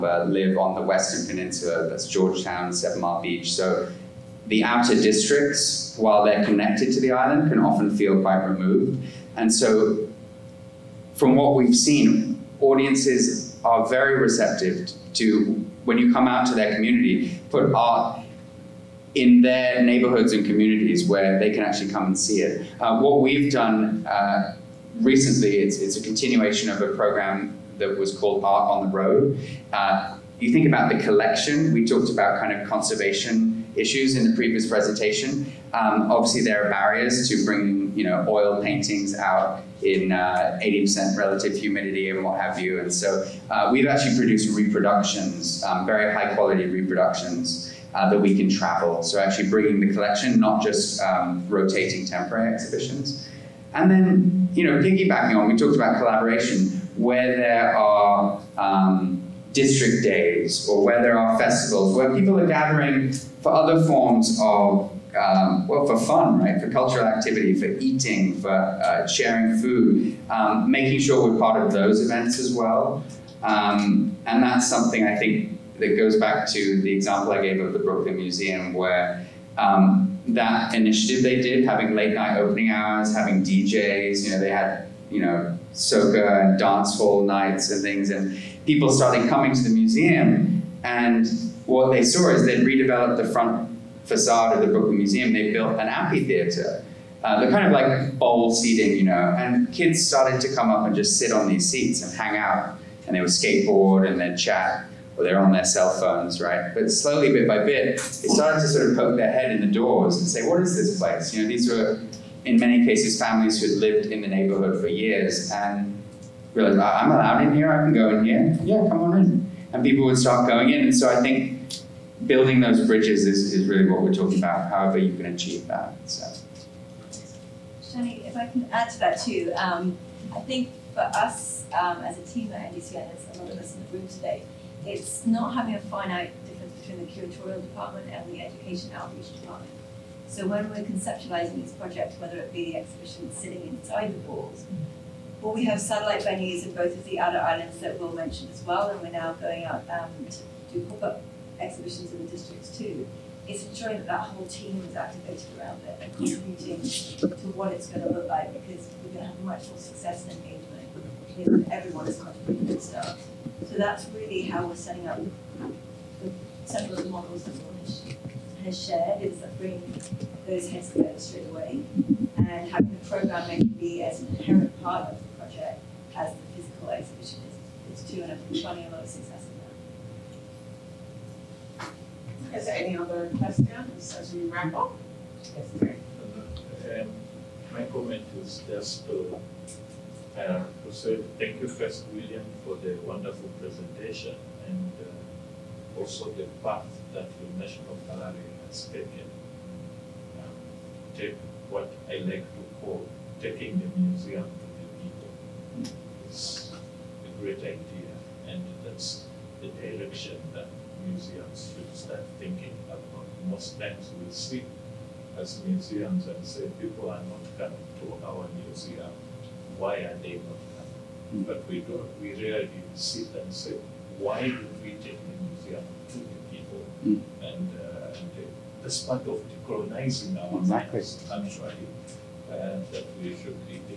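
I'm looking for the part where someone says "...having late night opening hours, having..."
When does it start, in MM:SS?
01:21.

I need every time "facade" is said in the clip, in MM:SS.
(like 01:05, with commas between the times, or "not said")
01:34.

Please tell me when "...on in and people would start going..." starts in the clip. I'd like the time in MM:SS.
01:59.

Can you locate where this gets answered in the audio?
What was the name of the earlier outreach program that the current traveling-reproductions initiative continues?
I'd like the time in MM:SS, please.
00:28.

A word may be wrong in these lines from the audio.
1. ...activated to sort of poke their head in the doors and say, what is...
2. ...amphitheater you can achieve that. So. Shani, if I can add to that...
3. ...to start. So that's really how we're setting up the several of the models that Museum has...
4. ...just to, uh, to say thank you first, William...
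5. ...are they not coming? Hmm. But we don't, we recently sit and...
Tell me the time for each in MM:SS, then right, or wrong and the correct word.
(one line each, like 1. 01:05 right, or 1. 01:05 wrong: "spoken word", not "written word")
1. 01:48 wrong: "started", not "activated"
2. 02:04 wrong: "however", not "amphitheater"
3. 02:42 wrong: "Will", not "Museum"
4. 03:08 right
5. 03:39 wrong: "rarely", not "recently".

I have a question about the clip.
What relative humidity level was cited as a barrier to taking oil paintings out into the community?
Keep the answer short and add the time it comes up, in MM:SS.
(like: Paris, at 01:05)
80%, at 00:40.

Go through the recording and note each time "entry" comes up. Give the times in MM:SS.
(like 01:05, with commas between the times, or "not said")
not said.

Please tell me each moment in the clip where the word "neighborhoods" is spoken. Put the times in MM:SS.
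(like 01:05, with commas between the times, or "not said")
00:19, 01:54.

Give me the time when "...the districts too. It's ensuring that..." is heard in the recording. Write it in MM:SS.
02:32.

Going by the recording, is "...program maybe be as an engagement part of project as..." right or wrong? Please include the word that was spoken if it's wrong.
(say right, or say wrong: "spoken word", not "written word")
wrong: "inherent", not "engagement".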